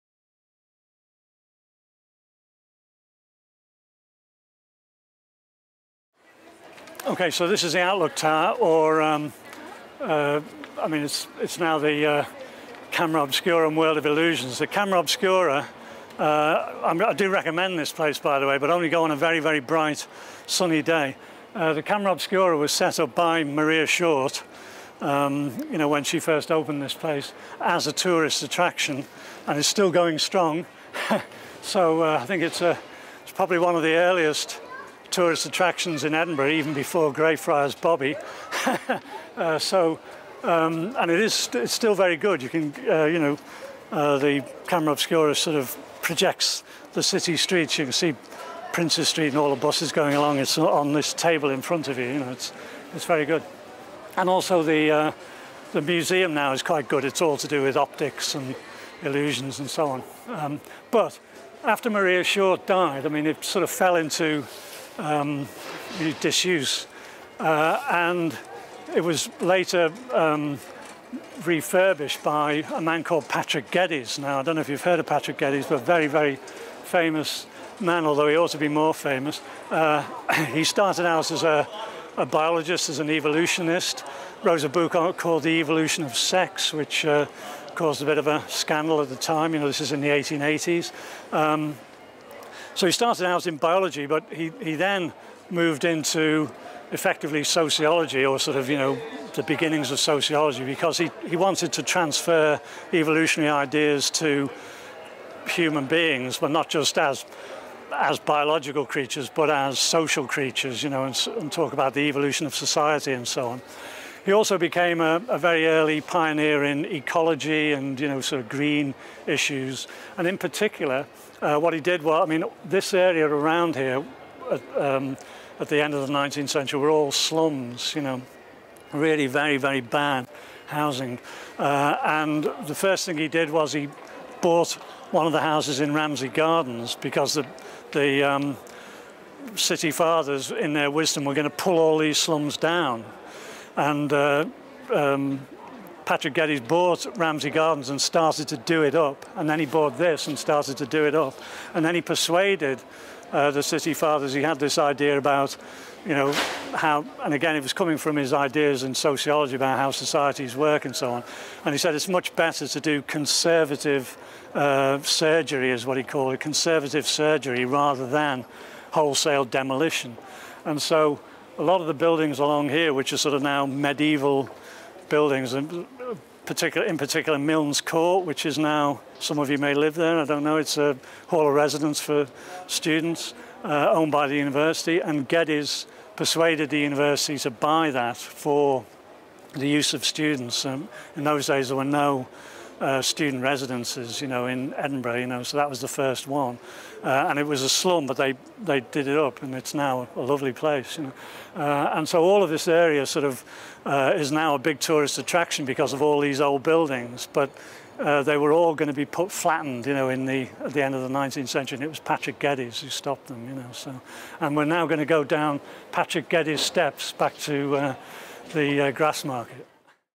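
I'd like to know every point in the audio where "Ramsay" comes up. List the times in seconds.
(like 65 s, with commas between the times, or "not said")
135 s, 147 s.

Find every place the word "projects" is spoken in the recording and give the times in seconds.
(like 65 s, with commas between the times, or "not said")
46 s.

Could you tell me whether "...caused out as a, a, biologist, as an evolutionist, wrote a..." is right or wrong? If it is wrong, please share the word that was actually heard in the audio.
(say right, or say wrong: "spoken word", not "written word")
wrong: "started", not "caused".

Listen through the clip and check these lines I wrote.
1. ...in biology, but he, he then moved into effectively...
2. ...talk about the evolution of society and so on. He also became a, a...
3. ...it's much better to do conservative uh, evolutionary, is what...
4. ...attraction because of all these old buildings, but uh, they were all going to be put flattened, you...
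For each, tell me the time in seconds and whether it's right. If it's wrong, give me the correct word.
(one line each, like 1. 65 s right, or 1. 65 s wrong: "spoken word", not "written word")
1. 93 s right
2. 111 s right
3. 161 s wrong: "surgery", not "evolutionary"
4. 205 s right.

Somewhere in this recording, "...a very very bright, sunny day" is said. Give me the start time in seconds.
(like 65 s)
19 s.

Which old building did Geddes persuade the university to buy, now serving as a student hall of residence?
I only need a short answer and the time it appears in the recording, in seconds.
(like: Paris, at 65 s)
Milne's Court, at 177 s.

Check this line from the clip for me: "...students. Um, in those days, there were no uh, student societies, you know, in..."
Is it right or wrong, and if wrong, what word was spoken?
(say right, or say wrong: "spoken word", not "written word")
wrong: "residences", not "societies".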